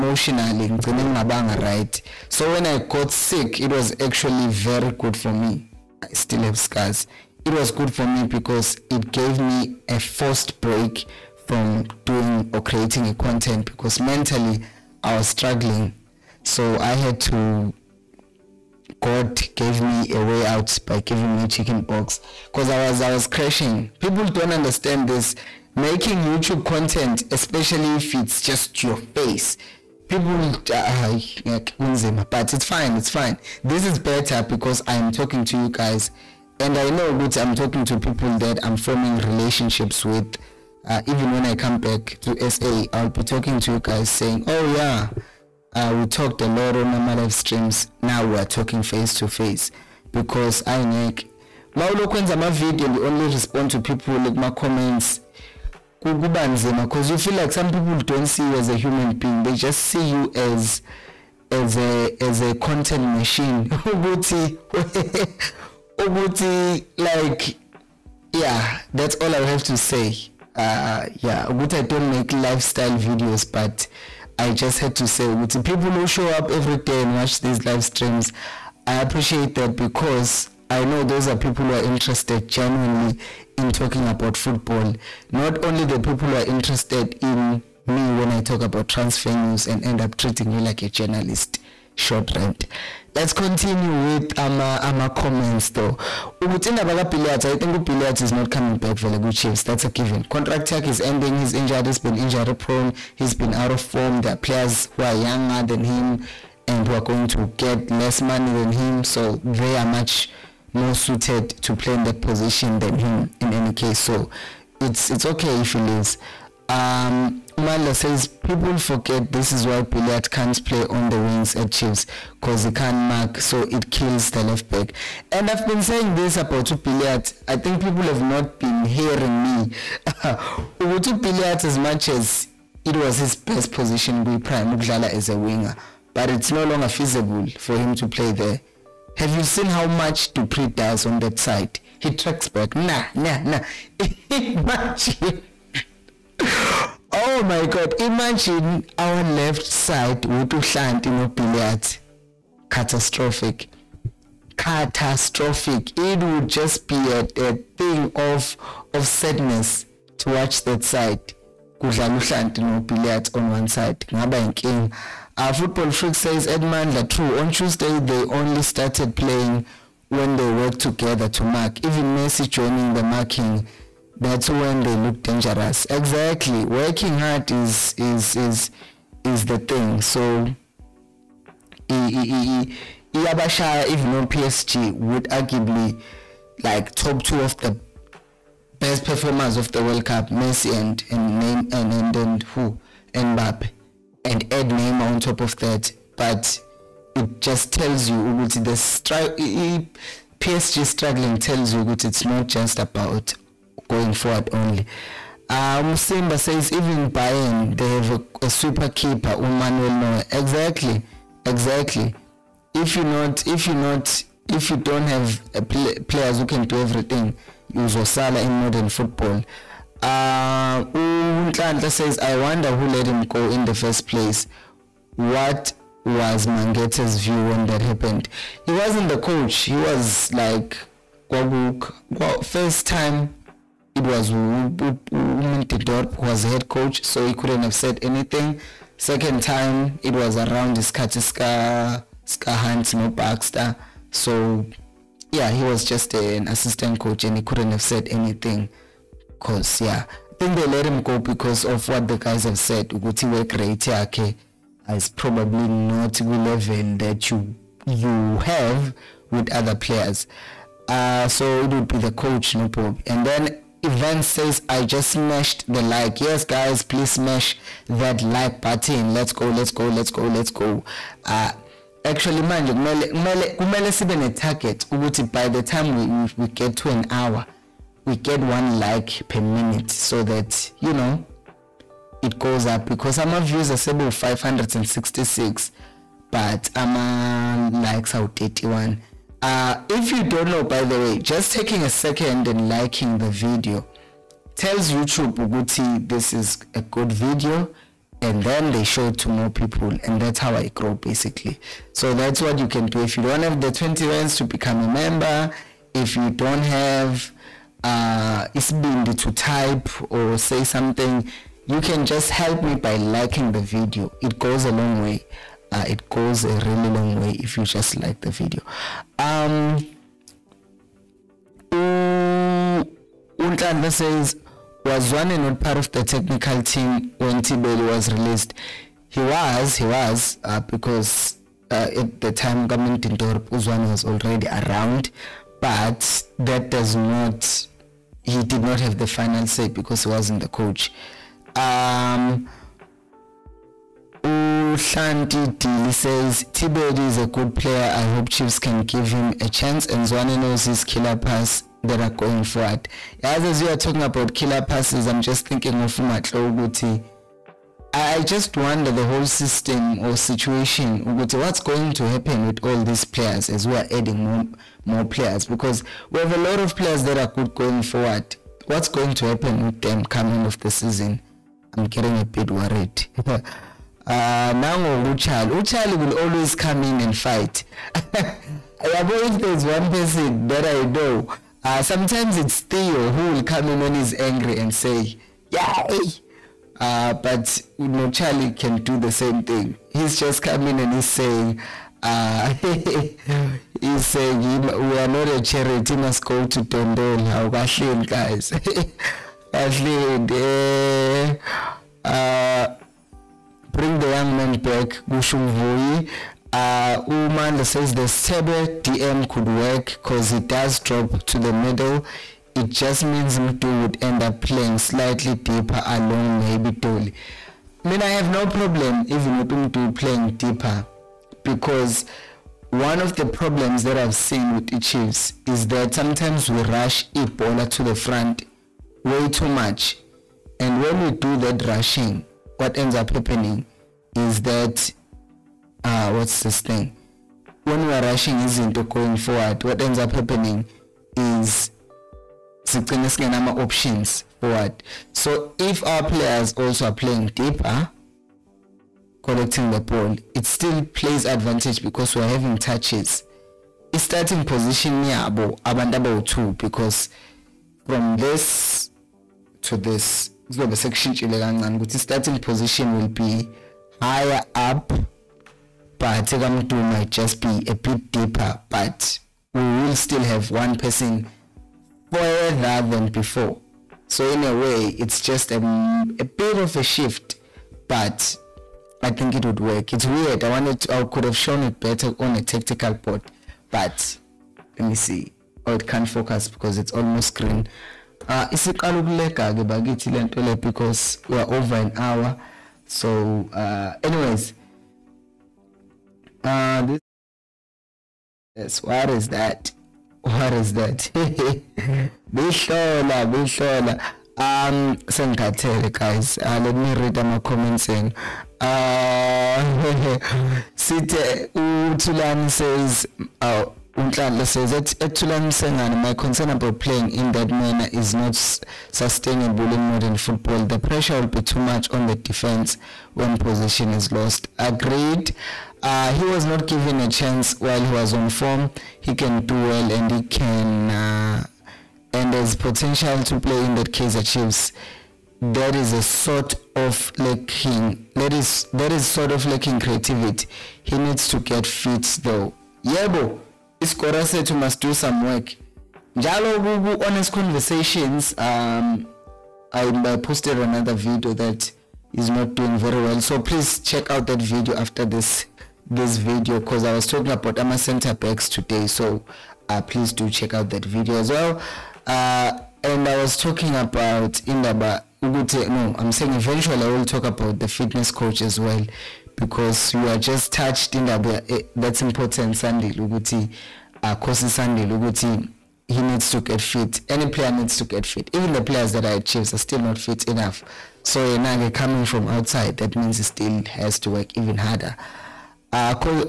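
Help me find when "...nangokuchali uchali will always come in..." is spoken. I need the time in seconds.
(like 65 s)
374 s.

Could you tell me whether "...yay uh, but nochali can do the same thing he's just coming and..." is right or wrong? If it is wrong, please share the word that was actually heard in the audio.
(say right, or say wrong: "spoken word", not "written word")
right.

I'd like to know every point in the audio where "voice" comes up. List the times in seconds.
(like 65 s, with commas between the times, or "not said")
not said.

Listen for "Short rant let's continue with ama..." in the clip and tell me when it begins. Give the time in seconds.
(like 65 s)
91 s.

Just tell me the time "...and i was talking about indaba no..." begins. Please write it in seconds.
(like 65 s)
562 s.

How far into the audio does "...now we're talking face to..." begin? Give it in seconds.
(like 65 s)
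48 s.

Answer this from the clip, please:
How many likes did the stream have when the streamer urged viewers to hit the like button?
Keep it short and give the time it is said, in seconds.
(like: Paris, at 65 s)
31, at 288 s.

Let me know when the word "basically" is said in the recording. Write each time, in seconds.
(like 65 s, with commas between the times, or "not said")
300 s.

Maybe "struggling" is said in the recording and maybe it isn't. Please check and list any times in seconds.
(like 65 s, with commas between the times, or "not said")
15 s, 200 s.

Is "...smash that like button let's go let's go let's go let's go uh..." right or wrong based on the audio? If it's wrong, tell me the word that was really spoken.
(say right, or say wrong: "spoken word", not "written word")
right.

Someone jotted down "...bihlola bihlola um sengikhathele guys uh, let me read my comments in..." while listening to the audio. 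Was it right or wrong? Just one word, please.
right.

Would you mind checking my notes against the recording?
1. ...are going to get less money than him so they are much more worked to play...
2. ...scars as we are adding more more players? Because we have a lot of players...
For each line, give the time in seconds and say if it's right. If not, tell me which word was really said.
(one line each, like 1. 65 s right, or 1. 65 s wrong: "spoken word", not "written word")
1. 106 s wrong: "suited", not "worked"
2. 363 s wrong: "players", not "scars".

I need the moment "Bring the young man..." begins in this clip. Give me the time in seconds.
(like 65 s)
403 s.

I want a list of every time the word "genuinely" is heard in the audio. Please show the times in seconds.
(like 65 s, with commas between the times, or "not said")
82 s.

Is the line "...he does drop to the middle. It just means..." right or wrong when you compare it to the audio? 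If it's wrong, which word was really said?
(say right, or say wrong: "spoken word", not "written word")
right.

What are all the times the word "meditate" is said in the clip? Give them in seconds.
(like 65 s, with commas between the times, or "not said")
not said.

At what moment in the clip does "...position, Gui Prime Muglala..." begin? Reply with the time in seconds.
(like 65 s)
133 s.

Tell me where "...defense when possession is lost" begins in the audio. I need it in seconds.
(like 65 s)
522 s.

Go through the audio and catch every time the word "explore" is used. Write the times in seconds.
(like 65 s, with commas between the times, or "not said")
not said.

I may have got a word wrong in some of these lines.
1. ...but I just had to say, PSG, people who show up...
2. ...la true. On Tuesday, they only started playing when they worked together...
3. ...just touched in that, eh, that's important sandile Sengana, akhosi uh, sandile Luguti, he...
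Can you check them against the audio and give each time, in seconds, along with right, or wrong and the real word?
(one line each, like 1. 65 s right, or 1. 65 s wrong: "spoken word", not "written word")
1. 73 s wrong: "Uguti", not "PSG"
2. 166 s right
3. 570 s wrong: "Luguti", not "Sengana".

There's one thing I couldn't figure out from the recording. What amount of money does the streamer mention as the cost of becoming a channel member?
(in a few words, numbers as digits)
20 rands.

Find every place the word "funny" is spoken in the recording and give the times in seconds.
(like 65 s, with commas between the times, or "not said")
not said.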